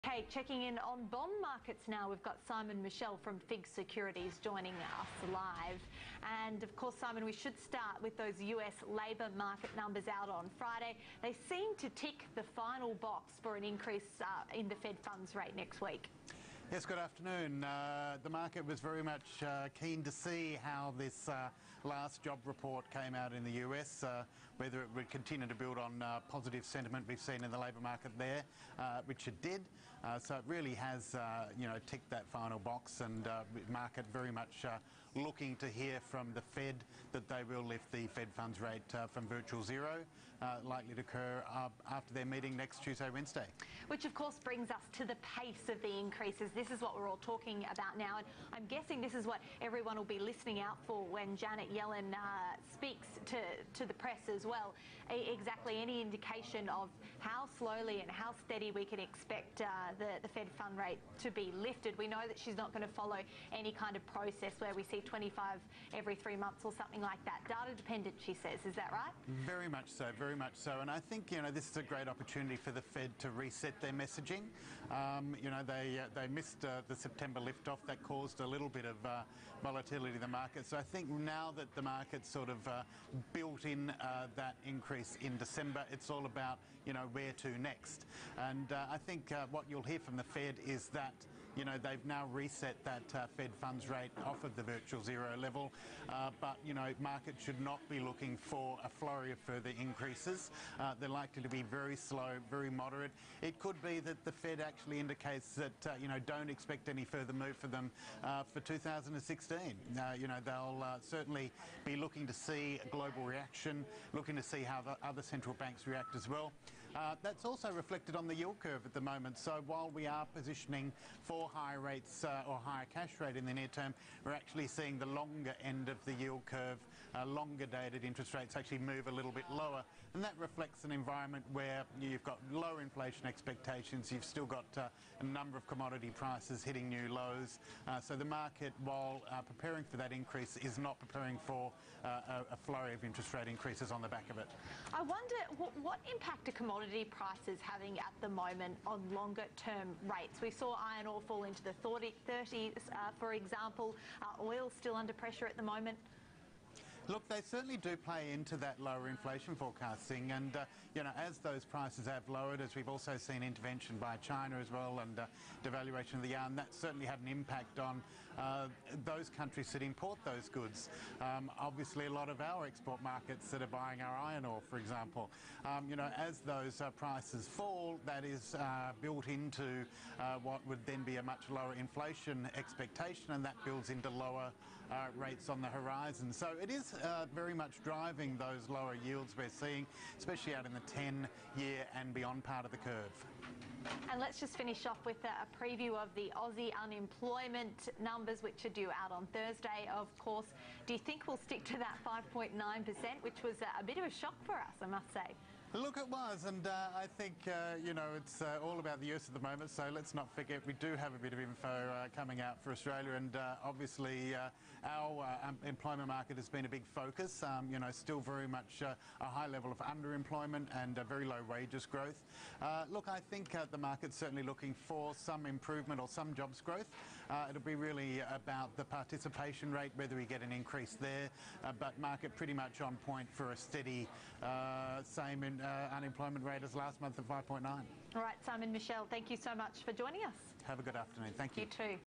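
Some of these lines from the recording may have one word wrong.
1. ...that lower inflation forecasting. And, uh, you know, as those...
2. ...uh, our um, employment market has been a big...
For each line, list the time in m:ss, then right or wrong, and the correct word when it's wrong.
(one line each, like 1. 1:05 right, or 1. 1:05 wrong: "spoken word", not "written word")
1. 2:38 right
2. 3:34 right.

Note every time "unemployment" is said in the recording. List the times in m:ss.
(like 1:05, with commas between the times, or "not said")
3:16, 3:55.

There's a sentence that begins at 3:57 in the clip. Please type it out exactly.
All right, Simon Michell, thank you so much for joining us.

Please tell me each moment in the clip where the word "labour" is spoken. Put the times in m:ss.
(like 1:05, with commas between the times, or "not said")
0:08, 0:27.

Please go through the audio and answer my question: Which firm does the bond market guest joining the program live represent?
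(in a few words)
FIIG Securities.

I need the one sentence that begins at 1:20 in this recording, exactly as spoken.
So I think now that the market's sort of uh, built in uh, that increase in December.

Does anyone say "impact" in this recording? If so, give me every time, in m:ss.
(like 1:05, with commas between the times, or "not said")
2:26, 2:47.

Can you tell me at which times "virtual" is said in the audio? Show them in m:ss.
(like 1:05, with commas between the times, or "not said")
0:39, 1:34.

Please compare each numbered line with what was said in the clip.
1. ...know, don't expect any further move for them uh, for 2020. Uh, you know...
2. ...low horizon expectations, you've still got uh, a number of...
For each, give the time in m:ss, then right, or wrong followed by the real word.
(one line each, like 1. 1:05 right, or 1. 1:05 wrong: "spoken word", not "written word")
1. 1:46 wrong: "2016", not "2020"
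2. 2:12 wrong: "inflation", not "horizon".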